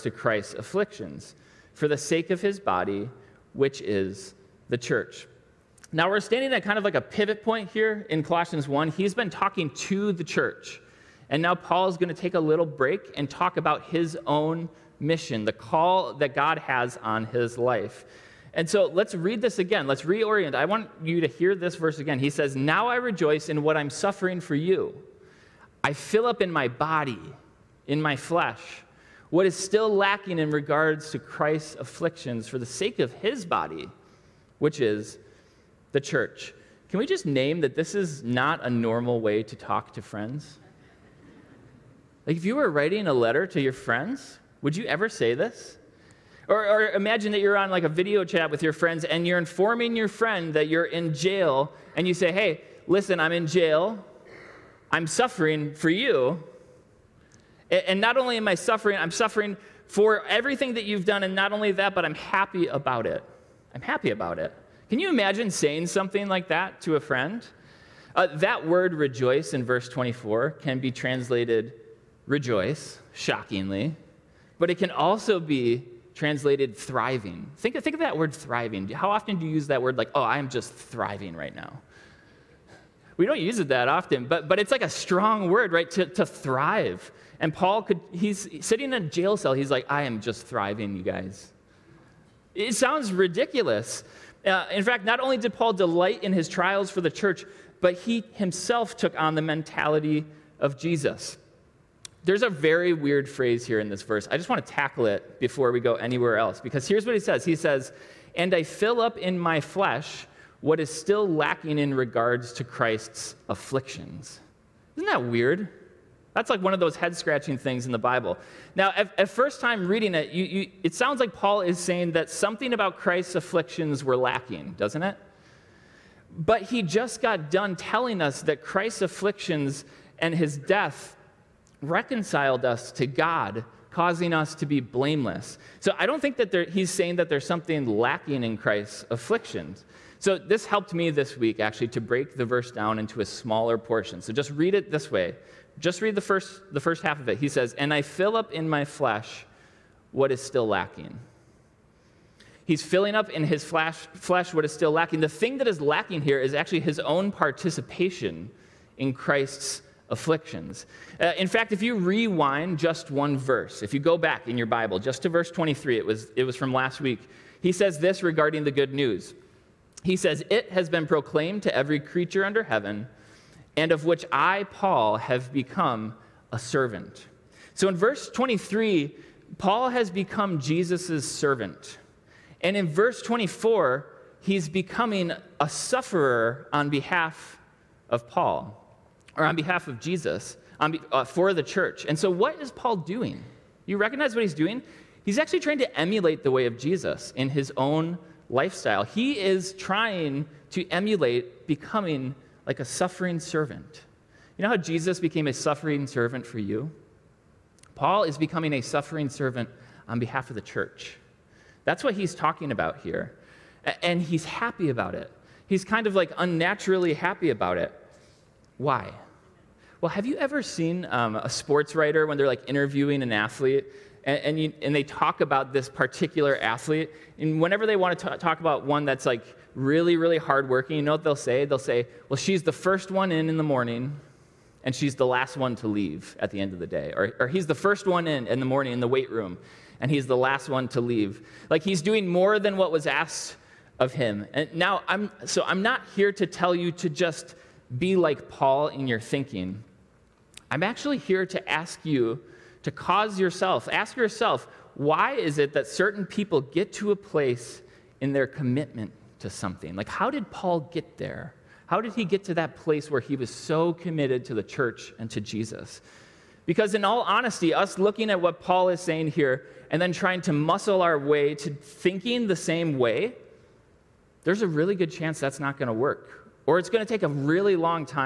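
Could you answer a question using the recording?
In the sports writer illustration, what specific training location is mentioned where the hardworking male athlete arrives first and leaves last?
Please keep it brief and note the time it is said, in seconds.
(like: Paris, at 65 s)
weight room, at 239 s.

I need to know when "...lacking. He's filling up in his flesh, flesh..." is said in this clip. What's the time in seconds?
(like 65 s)
150 s.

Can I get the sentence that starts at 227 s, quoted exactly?
And whenever they want to t- talk about one that's like really, really hardworking, you know what they'll say?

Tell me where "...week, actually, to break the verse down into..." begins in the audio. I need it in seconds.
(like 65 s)
141 s.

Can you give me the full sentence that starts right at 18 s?
And so let's read this again.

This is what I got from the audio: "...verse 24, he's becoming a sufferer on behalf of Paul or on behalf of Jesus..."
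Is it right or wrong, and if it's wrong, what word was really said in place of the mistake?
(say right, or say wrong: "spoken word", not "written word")
right.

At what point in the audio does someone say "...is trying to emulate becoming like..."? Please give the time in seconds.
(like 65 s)
199 s.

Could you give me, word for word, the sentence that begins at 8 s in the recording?
He's been talking to the church.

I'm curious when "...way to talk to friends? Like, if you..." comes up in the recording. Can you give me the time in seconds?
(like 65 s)
39 s.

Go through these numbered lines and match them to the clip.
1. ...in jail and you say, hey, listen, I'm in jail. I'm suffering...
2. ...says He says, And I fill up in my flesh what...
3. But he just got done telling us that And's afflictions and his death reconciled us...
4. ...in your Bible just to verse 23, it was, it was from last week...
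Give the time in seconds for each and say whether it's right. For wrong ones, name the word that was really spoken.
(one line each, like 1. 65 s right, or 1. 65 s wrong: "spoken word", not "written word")
1. 50 s right
2. 107 s right
3. 126 s wrong: "Christ", not "And"
4. 164 s right.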